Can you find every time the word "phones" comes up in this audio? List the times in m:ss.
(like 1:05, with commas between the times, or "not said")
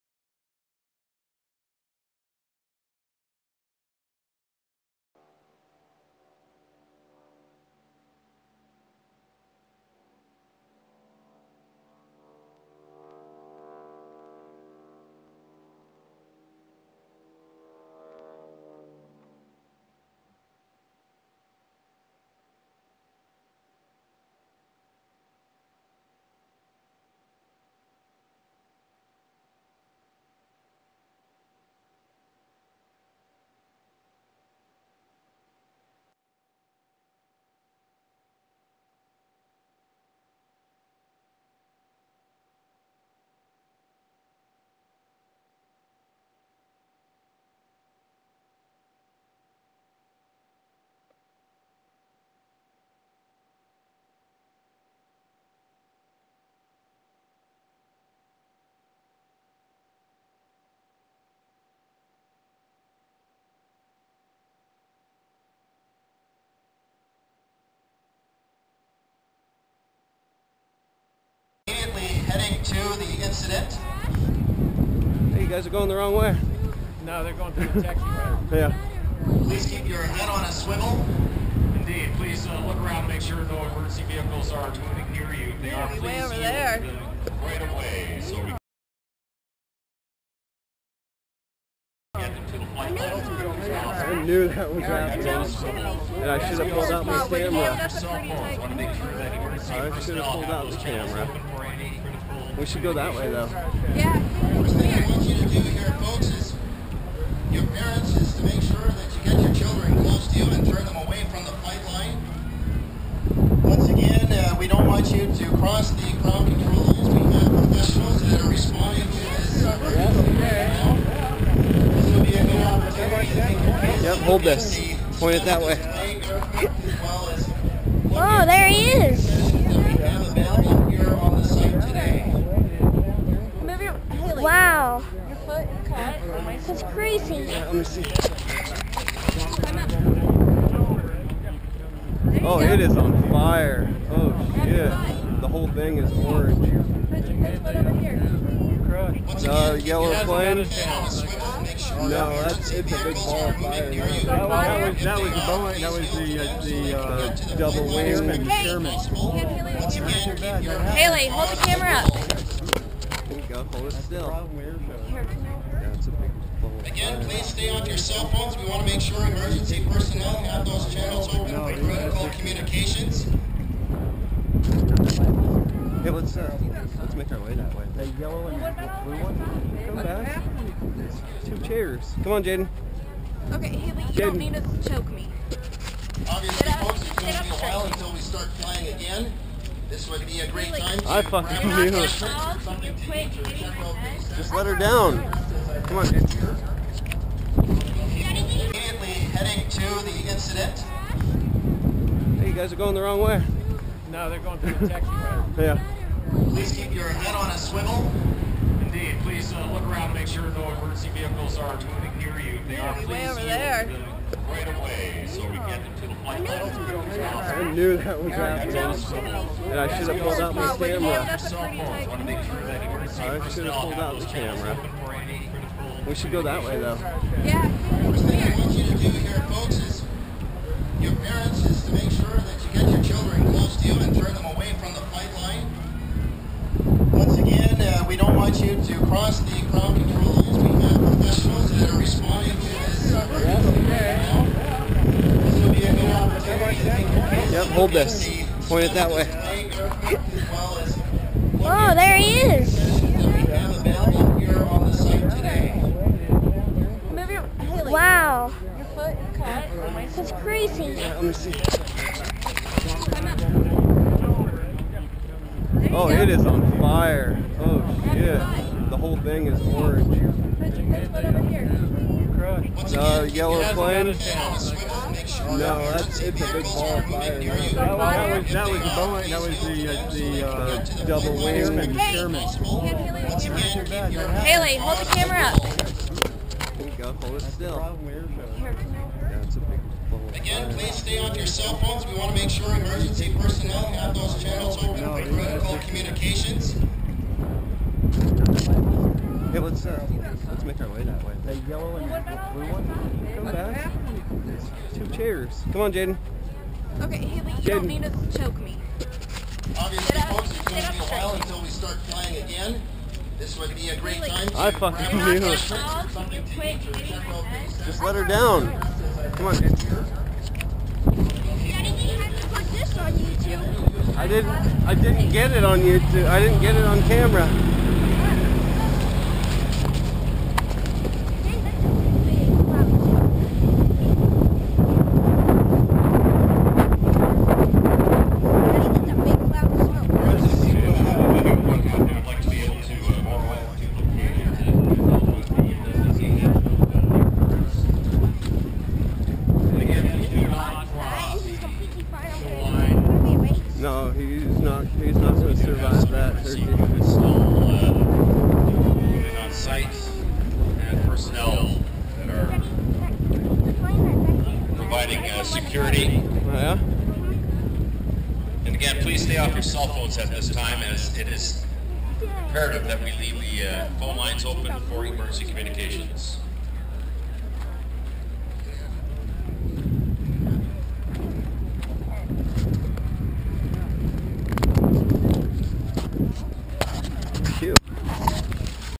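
2:48, 4:51, 6:09, 6:13.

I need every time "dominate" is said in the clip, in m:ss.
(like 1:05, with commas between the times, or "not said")
not said.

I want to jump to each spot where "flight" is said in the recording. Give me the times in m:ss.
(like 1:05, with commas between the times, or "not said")
1:51, 3:36, 3:55.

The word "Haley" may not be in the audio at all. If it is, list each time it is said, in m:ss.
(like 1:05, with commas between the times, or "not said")
2:40, 3:03, 4:44, 5:07, 5:14.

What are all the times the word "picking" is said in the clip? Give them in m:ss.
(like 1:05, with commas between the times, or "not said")
not said.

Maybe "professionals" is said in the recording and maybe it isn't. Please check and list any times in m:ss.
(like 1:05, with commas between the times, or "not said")
1:57, 4:01.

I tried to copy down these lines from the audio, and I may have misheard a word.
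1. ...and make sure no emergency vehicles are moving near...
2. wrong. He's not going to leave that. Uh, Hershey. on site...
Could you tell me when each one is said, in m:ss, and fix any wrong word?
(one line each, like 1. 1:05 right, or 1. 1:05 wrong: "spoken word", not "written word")
1. 3:30 right
2. 5:54 wrong: "survive", not "leave".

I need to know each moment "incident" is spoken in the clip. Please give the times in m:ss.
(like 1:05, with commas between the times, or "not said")
1:13, 3:20.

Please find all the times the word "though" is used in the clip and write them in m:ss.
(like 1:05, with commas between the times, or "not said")
1:43, 3:46.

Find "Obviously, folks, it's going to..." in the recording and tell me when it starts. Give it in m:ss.
3:06.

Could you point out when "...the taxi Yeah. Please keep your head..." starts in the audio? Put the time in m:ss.
1:17.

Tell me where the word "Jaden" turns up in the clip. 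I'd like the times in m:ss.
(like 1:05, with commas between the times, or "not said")
3:02, 5:05, 5:19.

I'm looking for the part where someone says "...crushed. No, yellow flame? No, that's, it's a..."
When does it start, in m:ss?
4:32.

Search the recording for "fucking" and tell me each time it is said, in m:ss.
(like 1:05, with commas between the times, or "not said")
3:11, 5:14.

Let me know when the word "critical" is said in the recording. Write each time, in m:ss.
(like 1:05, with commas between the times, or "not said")
2:51, 4:55.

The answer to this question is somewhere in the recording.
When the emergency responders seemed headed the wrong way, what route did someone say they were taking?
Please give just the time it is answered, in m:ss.
3:24.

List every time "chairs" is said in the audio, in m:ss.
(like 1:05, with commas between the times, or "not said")
3:01, 5:05.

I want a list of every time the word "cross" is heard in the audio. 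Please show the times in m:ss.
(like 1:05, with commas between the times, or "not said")
1:55, 3:59.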